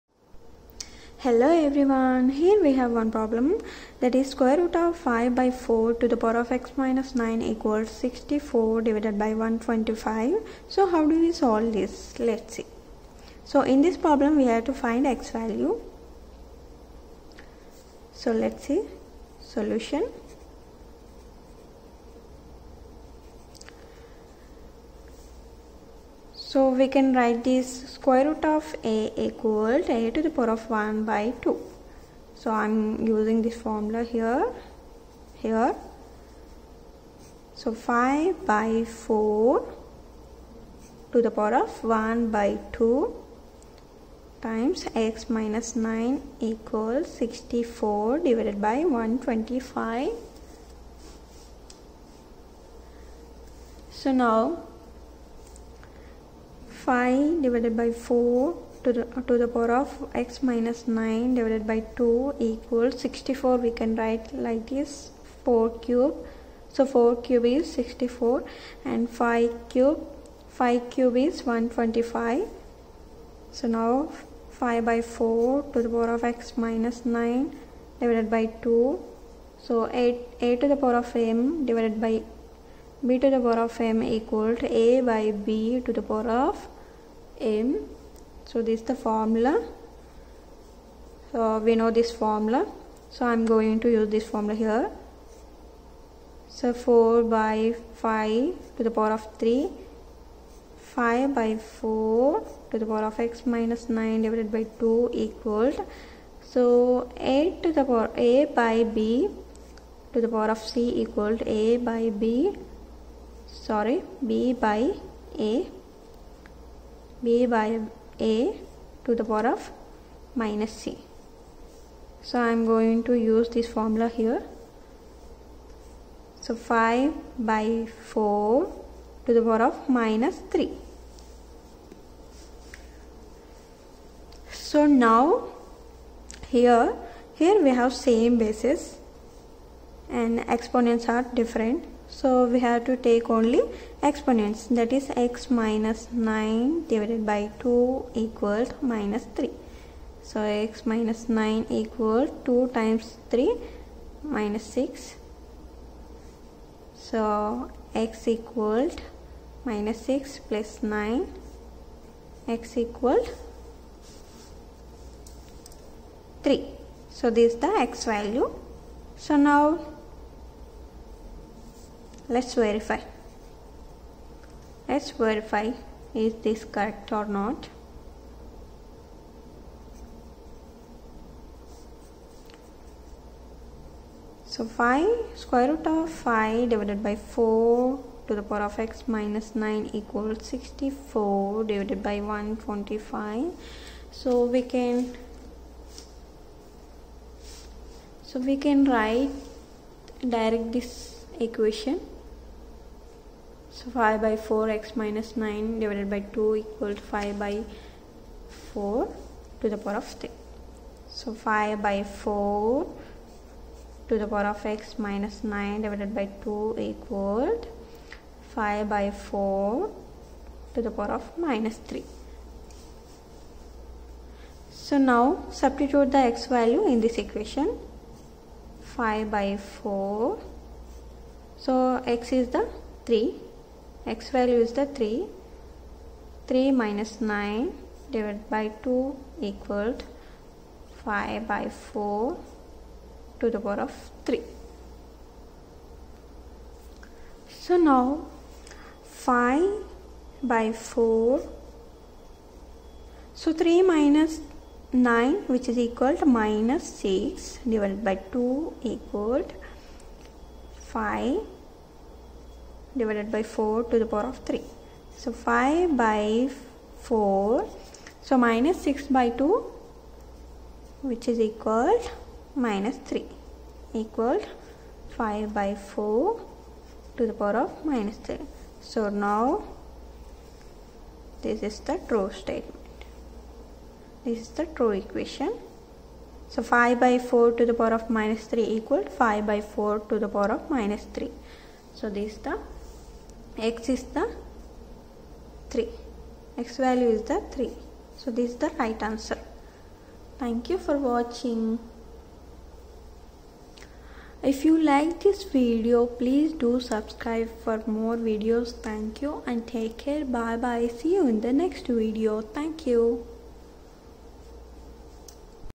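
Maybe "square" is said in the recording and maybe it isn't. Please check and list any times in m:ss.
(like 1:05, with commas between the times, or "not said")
0:04, 0:27, 3:05.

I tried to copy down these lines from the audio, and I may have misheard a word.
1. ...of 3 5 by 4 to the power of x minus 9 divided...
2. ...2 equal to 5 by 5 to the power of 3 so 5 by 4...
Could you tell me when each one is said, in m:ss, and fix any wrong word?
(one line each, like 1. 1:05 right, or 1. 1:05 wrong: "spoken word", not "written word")
1. 1:39 right
2. 3:26 wrong: "4", not "5".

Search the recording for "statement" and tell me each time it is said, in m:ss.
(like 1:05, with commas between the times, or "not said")
4:42.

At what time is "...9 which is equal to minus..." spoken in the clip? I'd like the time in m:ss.
4:14.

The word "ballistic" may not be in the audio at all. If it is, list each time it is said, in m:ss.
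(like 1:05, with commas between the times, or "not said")
not said.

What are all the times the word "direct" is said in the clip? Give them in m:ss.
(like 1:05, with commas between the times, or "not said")
3:20.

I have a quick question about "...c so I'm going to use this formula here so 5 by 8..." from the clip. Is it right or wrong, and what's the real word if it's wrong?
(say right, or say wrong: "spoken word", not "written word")
wrong: "4", not "8".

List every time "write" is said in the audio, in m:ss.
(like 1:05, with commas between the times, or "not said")
0:27, 1:03, 3:18.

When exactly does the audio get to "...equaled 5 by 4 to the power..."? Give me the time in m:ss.
3:59.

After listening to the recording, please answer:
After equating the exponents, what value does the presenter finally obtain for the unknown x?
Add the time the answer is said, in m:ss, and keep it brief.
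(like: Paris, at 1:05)
3, at 2:42.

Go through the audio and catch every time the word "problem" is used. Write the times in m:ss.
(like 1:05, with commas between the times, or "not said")
0:03, 0:13.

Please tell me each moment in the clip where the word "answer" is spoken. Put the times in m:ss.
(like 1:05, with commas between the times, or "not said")
4:59.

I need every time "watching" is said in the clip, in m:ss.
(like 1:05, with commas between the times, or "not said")
5:00.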